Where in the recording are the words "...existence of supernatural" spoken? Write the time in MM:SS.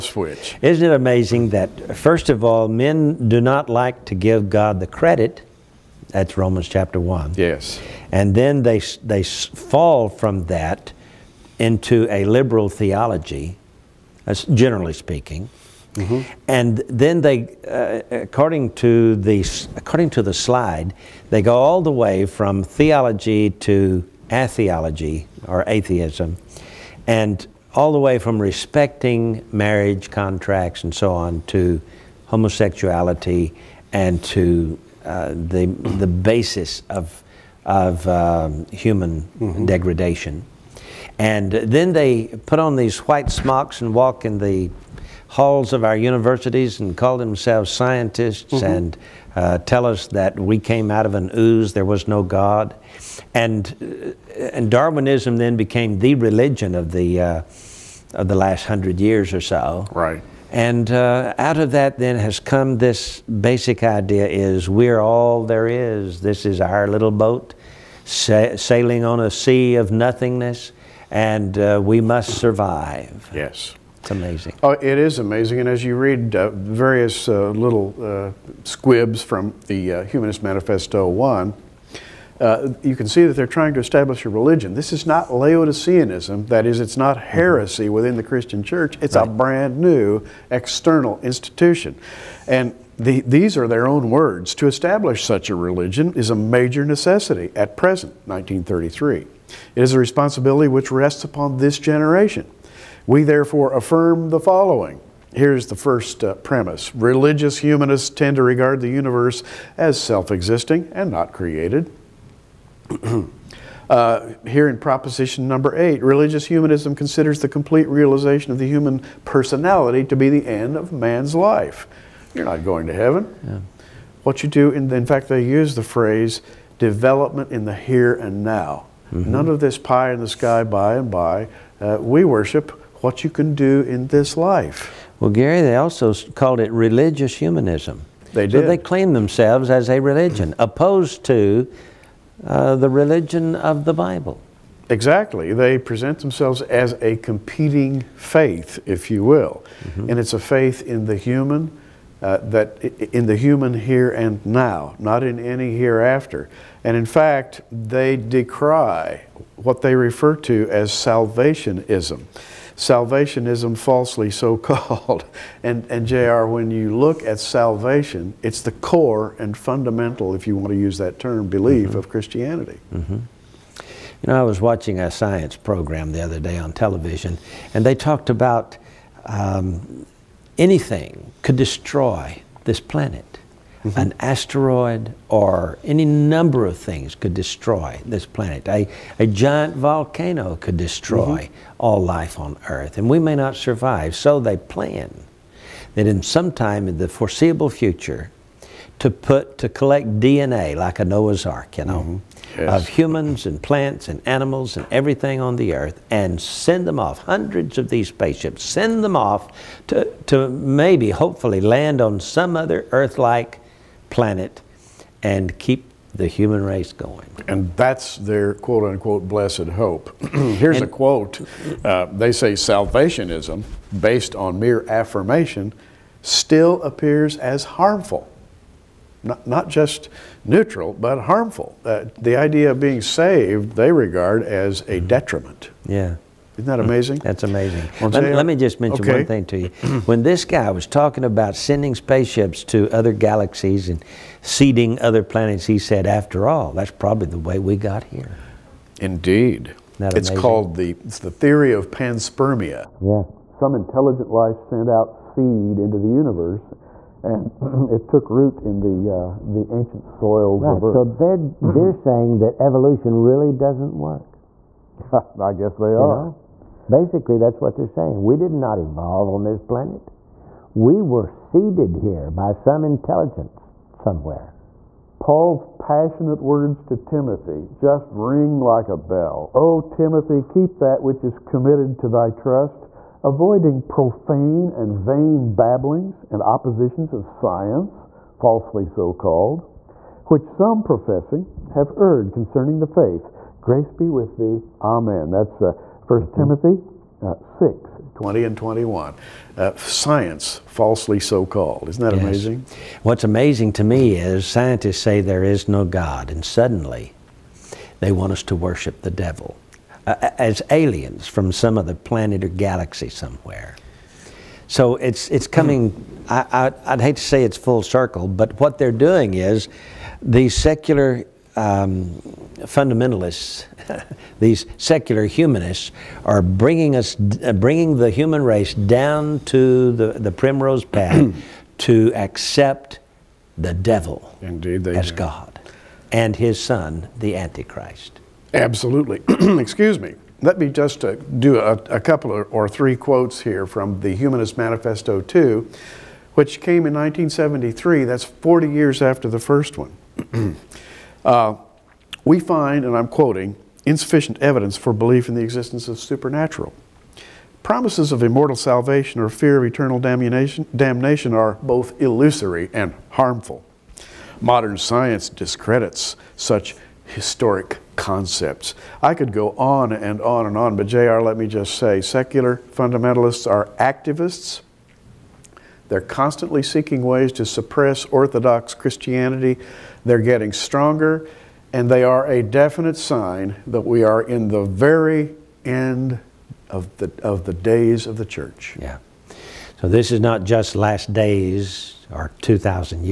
05:55.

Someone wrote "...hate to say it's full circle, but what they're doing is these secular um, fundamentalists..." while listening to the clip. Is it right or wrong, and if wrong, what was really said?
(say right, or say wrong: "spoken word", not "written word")
right.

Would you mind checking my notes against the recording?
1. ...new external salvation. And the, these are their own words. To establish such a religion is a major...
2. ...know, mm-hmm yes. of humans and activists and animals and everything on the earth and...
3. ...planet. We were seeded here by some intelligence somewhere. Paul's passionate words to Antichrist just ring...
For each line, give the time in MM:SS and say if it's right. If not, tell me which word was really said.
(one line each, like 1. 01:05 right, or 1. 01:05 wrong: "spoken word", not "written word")
1. 01:29 wrong: "institution", not "salvation"
2. 03:21 wrong: "plants", not "activists"
3. 04:29 wrong: "Timothy", not "Antichrist".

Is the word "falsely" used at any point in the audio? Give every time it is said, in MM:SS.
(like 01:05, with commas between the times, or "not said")
02:43, 04:48, 05:00.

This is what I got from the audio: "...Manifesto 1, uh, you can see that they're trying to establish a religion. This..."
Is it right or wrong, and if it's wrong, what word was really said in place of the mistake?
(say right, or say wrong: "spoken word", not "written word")
right.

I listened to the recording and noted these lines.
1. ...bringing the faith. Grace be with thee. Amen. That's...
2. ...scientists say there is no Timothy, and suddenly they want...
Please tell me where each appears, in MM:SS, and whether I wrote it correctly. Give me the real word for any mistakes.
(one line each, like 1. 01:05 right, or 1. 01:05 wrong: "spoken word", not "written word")
1. 04:52 wrong: "concerning", not "bringing"
2. 05:04 wrong: "God", not "Timothy".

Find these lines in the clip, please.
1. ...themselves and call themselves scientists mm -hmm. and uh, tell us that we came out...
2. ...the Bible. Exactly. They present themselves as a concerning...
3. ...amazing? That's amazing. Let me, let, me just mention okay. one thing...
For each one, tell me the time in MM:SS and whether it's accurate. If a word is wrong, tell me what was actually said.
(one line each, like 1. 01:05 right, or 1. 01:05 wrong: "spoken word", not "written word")
1. 00:45 wrong: "universities", not "themselves"
2. 02:23 wrong: "competing", not "concerning"
3. 03:56 right.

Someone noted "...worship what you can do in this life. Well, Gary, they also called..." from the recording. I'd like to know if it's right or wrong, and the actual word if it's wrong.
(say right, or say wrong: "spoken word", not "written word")
right.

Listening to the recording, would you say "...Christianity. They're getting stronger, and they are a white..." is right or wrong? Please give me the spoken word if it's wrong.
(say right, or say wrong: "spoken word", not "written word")
wrong: "definite", not "white".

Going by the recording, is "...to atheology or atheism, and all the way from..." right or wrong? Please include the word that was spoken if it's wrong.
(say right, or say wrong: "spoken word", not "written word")
right.